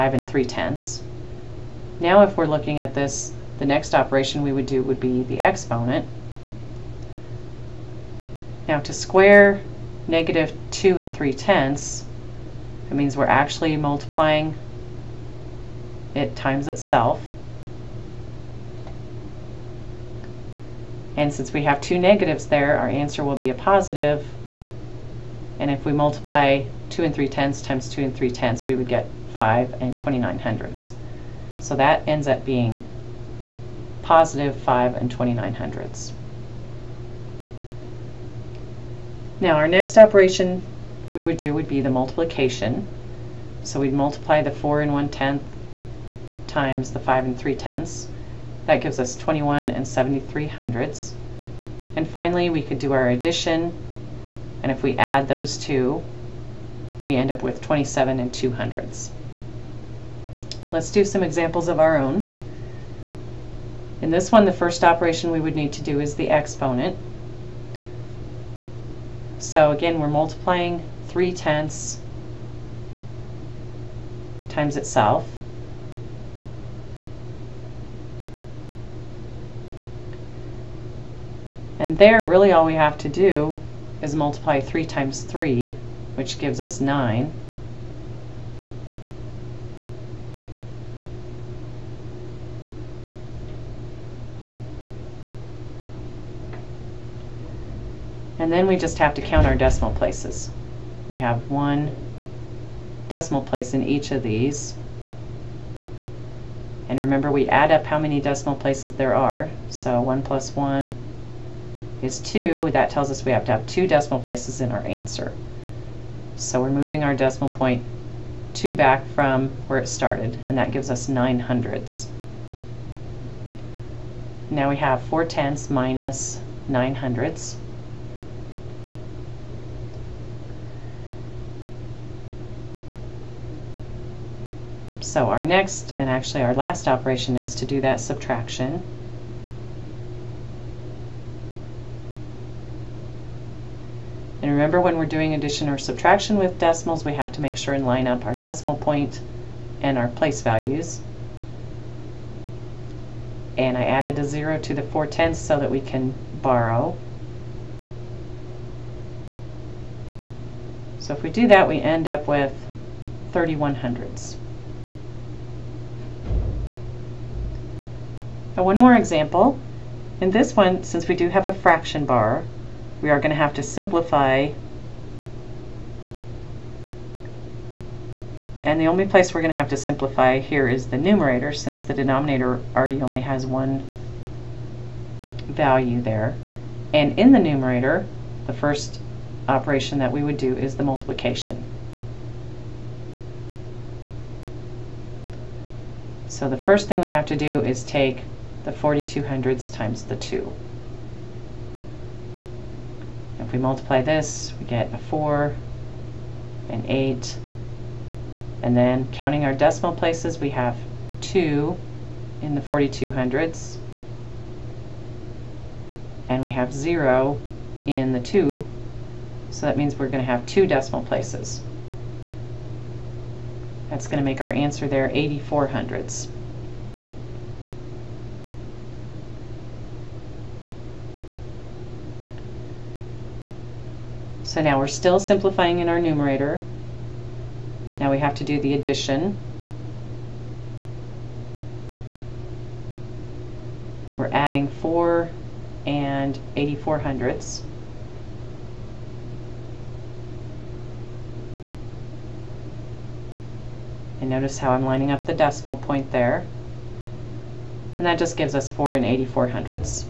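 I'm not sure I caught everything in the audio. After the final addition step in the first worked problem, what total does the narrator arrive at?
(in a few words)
27.02.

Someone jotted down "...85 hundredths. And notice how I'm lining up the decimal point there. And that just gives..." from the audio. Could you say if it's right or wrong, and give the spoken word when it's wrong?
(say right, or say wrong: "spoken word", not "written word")
wrong: "84", not "85".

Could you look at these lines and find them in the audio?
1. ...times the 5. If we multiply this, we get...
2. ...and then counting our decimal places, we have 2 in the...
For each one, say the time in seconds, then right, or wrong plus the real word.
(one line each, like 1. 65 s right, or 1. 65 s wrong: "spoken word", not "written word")
1. 199 s wrong: "2", not "5"
2. 208 s right.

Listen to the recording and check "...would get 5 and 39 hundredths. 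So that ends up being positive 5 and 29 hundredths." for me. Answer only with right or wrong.
wrong.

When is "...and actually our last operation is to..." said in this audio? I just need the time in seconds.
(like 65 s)
135 s.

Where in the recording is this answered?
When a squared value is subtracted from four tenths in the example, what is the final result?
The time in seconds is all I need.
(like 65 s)
163 s.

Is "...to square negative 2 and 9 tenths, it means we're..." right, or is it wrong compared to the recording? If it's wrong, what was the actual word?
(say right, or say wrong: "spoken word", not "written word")
wrong: "3", not "9".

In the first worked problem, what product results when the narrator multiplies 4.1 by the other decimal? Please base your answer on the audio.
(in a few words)
21.73.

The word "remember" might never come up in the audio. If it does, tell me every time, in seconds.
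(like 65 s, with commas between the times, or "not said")
106 s, 144 s.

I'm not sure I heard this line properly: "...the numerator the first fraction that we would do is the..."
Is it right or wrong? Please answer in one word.
wrong.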